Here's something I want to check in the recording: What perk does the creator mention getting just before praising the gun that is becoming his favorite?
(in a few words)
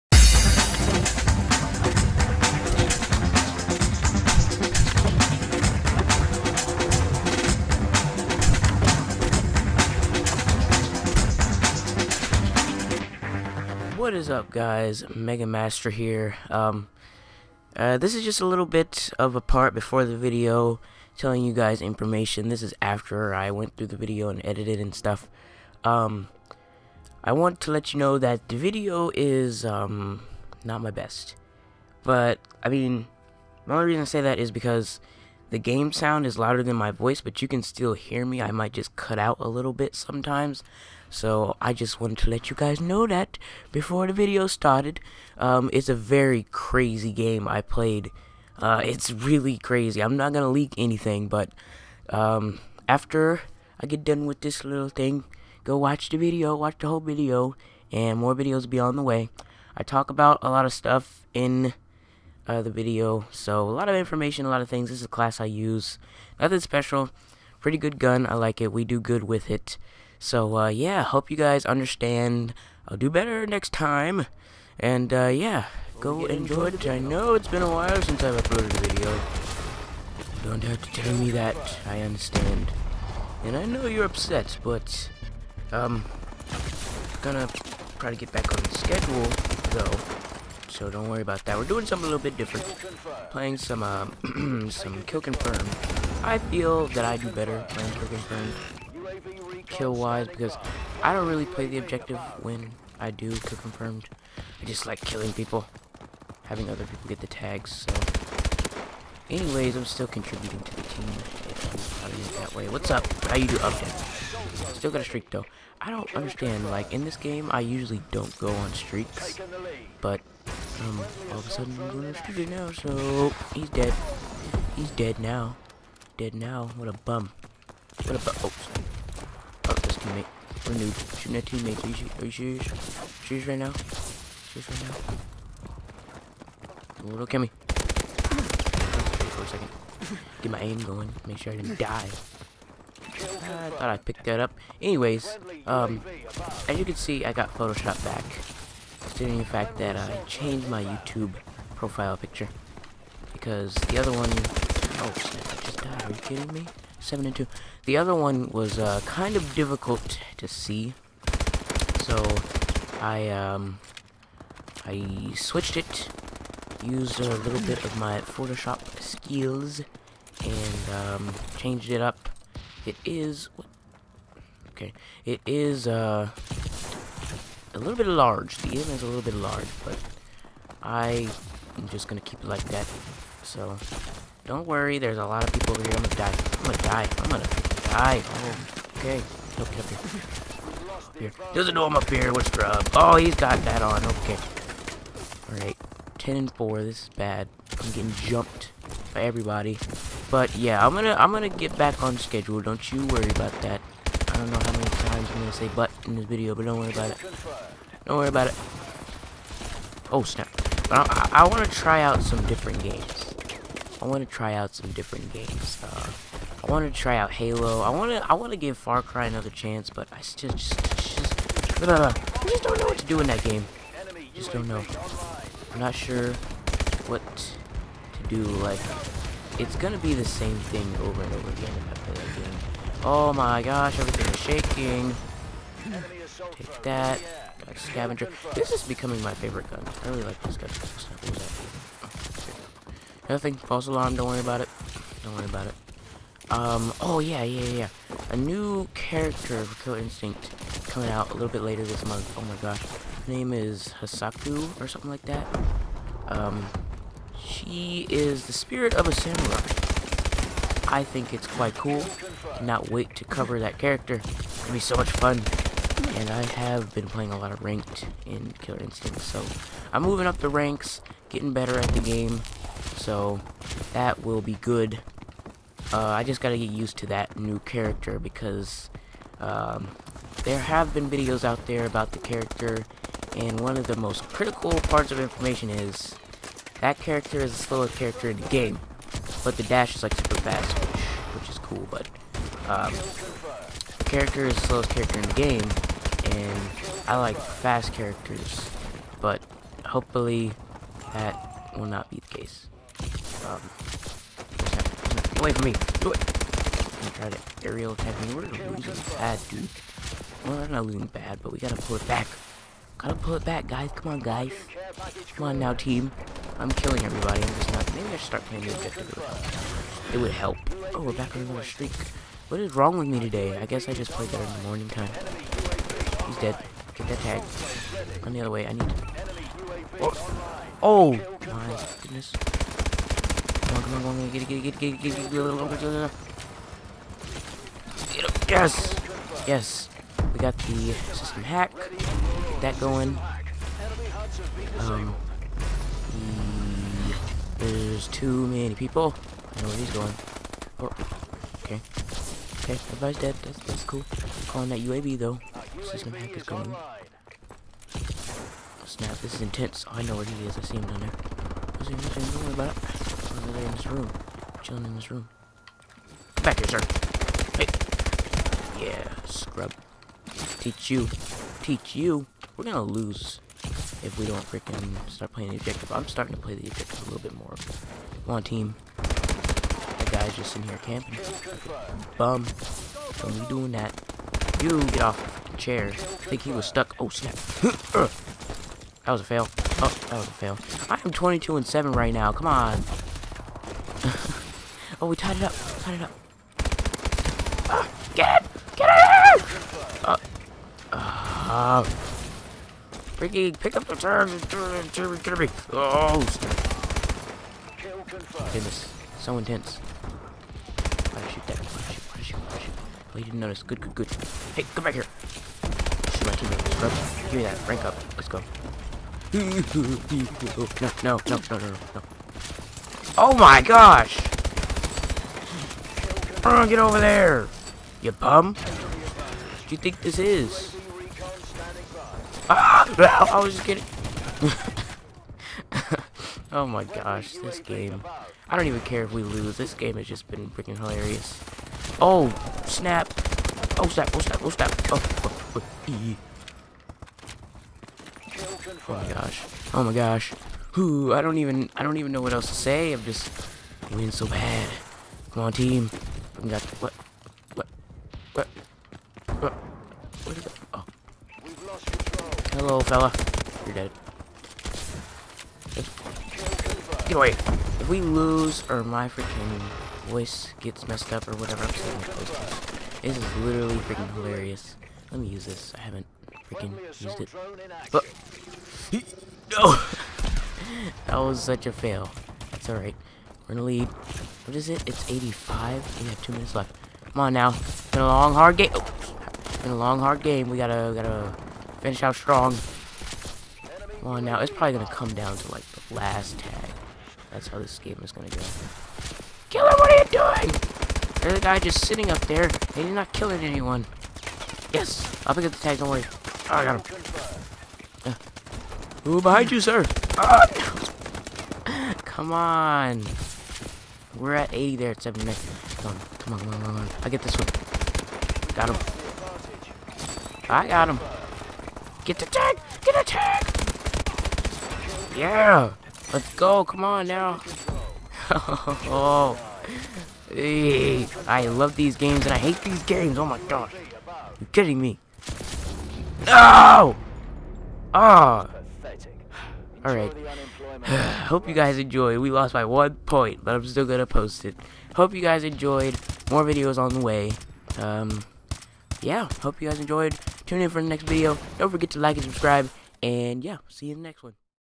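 Scavenger.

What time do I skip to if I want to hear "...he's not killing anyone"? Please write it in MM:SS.
08:22.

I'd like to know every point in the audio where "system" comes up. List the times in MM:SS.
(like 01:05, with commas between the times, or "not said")
05:40, 05:55.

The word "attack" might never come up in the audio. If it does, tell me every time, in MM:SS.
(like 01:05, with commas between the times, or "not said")
05:07.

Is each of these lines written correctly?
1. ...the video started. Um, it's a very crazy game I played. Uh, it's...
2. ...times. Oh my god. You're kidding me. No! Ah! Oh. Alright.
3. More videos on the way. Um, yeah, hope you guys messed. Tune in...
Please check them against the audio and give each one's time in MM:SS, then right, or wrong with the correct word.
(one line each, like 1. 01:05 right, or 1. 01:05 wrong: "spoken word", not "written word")
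1. 00:44 right
2. 08:52 wrong: "games", not "times"
3. 09:06 wrong: "enjoyed", not "messed".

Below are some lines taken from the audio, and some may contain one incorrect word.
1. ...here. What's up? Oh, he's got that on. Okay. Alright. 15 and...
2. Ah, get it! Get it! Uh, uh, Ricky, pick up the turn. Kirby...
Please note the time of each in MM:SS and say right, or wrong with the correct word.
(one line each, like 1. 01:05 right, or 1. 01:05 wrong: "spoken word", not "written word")
1. 03:12 wrong: "10", not "15"
2. 06:37 right.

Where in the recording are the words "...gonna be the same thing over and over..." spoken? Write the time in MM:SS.
03:49.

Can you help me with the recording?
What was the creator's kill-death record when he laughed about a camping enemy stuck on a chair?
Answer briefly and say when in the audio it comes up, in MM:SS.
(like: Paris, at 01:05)
22 and 7, at 06:31.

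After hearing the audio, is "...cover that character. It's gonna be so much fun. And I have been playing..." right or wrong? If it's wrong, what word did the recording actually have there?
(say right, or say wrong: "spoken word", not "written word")
right.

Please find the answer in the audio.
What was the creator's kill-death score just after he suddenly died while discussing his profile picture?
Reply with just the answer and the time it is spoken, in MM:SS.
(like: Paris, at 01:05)
7 and 2, at 02:36.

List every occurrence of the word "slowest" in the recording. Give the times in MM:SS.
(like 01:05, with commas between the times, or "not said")
04:47, 04:54.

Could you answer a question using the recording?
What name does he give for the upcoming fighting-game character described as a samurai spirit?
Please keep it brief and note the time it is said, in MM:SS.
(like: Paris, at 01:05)
Hasaku, at 04:14.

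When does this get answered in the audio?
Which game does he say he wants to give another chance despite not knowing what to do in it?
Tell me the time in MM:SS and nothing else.
03:38.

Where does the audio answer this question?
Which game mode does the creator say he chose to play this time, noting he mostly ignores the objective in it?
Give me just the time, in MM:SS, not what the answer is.
01:43.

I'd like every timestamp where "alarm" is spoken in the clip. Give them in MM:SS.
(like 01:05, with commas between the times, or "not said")
04:03.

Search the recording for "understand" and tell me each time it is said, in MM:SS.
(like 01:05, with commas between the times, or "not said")
01:11, 01:22, 01:56.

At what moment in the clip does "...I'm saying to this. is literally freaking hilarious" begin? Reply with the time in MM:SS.
07:51.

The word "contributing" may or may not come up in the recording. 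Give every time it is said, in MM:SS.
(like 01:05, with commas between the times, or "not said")
01:50.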